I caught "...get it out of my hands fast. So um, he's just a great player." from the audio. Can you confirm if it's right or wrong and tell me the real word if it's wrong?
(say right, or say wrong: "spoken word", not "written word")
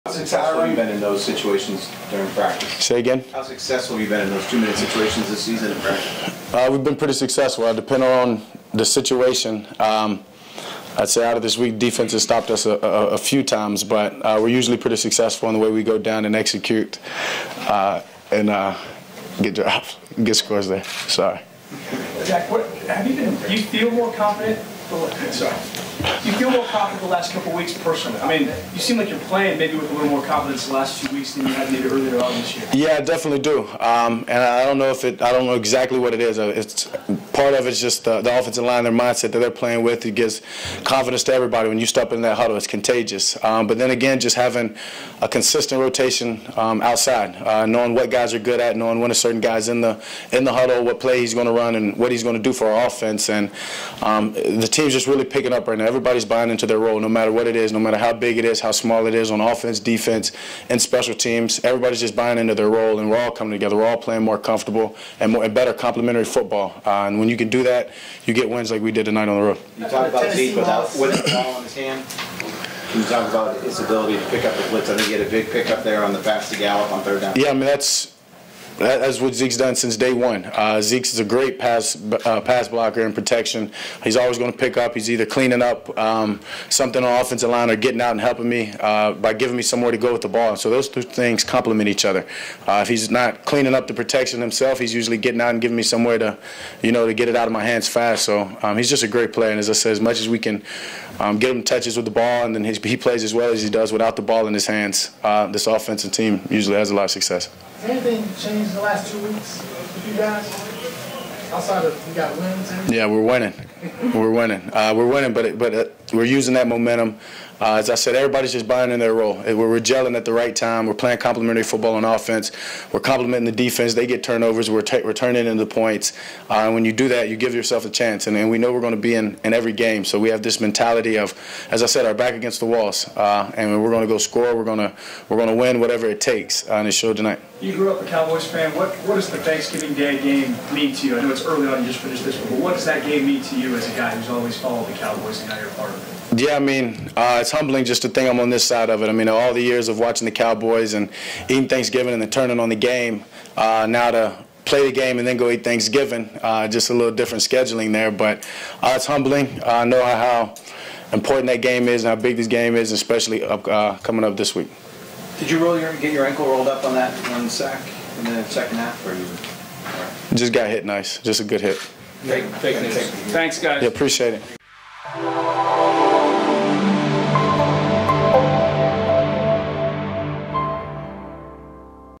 right.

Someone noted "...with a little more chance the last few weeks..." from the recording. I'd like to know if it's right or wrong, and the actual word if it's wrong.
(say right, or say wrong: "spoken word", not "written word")
wrong: "confidence", not "chance".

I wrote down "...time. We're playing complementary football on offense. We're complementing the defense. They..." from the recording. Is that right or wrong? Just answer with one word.
right.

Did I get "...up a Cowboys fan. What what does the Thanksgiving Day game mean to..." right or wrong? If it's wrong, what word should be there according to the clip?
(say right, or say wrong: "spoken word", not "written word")
right.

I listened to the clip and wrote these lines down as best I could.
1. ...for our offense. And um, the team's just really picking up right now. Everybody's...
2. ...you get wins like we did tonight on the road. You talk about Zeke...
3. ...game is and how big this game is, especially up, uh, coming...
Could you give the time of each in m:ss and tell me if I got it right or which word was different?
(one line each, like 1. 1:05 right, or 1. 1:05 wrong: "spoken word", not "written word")
1. 0:52 right
2. 1:08 right
3. 2:41 right.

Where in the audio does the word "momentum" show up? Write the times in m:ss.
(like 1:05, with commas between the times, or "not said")
1:56.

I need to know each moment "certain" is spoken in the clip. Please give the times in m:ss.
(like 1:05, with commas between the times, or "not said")
0:49.